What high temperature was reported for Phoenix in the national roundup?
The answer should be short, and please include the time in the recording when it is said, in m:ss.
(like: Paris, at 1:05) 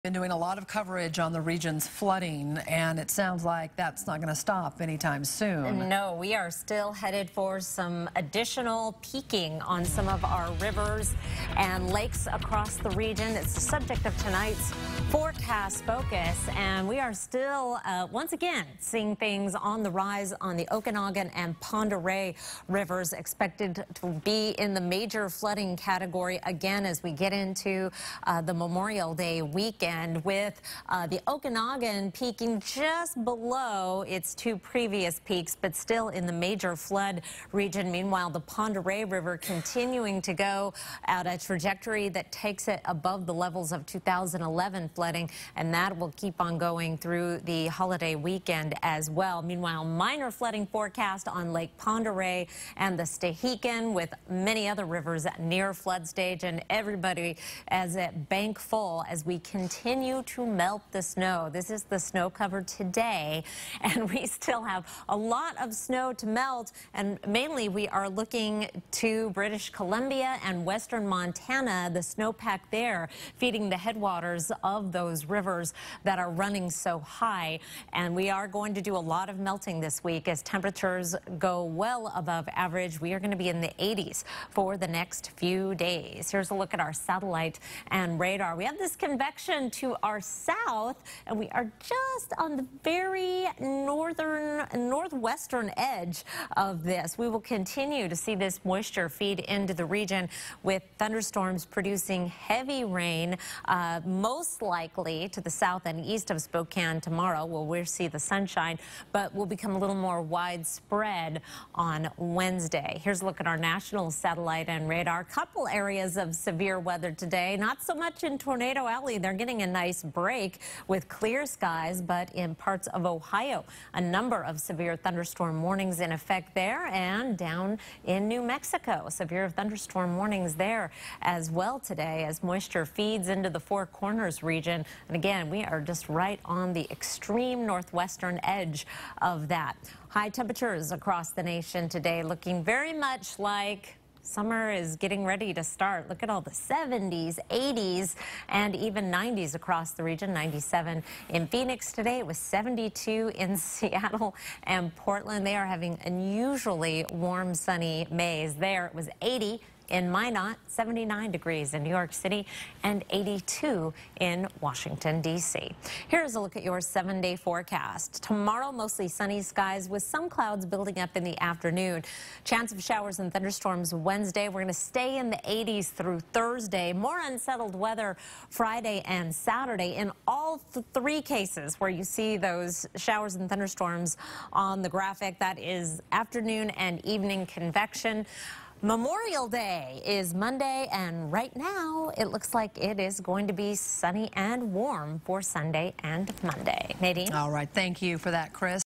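97, at 2:30.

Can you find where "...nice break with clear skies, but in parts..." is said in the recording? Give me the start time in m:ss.
1:59.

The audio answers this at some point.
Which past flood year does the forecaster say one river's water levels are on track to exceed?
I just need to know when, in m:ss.
0:43.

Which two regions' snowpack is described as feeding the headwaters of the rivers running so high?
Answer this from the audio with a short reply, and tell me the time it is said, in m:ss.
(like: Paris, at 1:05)
British Columbia and western Montana, at 1:09.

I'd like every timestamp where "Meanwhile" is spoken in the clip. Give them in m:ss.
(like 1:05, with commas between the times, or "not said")
0:37, 0:49.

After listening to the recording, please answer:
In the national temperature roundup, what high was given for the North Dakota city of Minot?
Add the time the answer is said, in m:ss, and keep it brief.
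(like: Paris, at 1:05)
80, at 2:39.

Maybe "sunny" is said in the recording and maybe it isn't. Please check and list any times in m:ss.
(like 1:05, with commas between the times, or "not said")
2:37, 2:49, 3:13.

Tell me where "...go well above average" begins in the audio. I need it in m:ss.
1:21.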